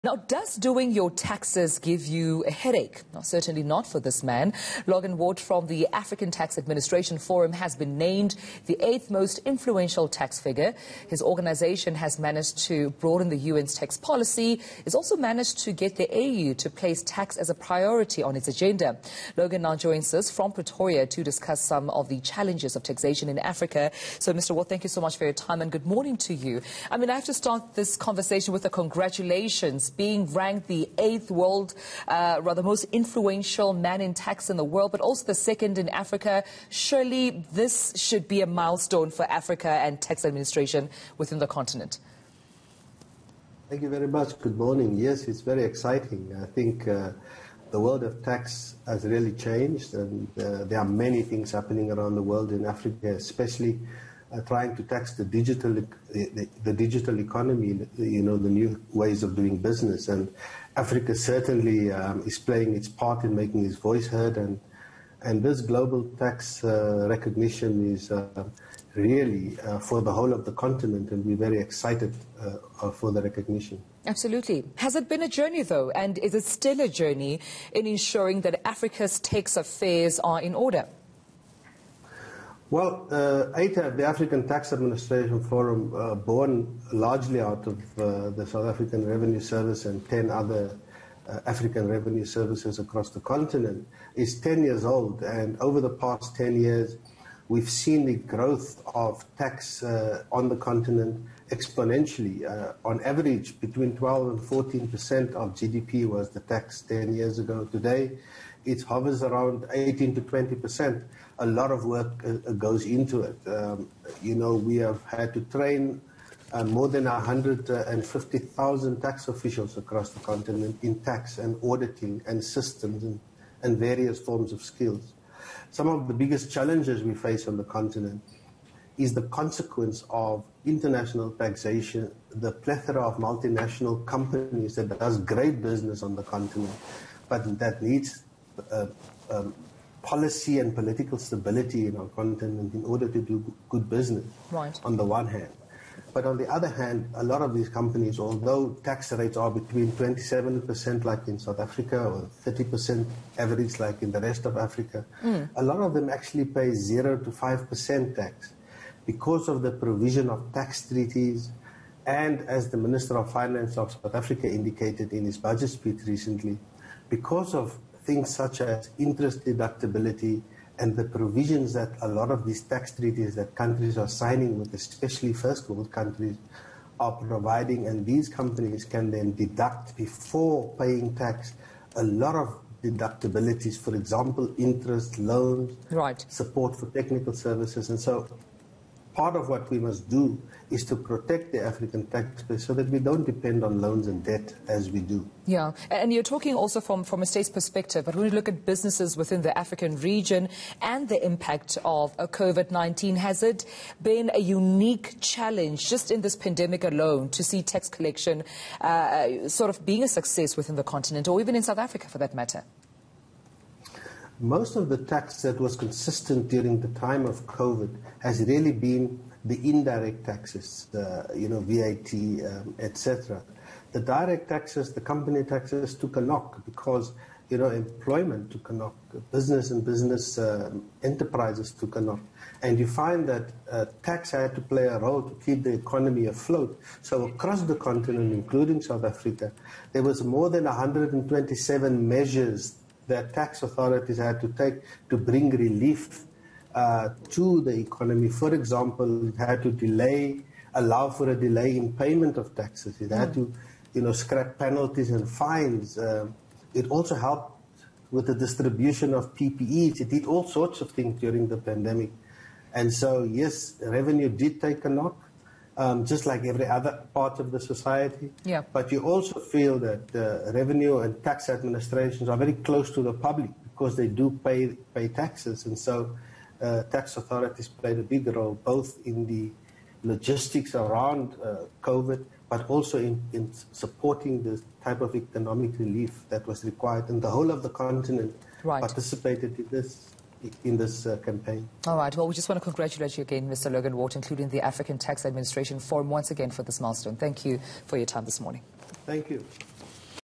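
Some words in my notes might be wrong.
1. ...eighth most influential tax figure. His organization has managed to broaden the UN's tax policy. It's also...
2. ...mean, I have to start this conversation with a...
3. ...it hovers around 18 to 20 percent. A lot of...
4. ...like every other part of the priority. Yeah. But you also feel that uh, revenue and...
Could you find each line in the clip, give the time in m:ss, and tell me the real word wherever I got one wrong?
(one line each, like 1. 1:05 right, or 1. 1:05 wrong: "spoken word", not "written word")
1. 0:08 right
2. 0:26 right
3. 1:48 right
4. 4:26 wrong: "society", not "priority".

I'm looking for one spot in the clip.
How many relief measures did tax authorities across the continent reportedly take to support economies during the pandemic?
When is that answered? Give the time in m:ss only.
4:00.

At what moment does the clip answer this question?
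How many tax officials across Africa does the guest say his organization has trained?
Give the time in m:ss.
1:57.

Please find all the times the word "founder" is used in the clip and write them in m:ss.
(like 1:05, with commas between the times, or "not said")
not said.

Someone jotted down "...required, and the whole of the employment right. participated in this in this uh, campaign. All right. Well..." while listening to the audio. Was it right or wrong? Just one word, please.
wrong.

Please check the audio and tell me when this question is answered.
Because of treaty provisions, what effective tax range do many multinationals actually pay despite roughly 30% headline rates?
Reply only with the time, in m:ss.
2:36.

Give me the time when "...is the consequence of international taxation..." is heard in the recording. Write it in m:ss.
2:08.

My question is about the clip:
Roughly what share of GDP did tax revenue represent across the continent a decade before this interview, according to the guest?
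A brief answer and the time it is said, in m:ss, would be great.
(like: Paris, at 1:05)
12 to 14 percent, at 1:43.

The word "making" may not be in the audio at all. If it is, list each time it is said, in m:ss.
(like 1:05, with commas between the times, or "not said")
1:03.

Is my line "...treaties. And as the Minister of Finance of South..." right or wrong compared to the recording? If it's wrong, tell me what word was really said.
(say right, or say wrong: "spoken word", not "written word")
right.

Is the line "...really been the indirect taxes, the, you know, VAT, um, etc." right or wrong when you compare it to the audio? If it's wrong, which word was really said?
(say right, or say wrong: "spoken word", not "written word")
right.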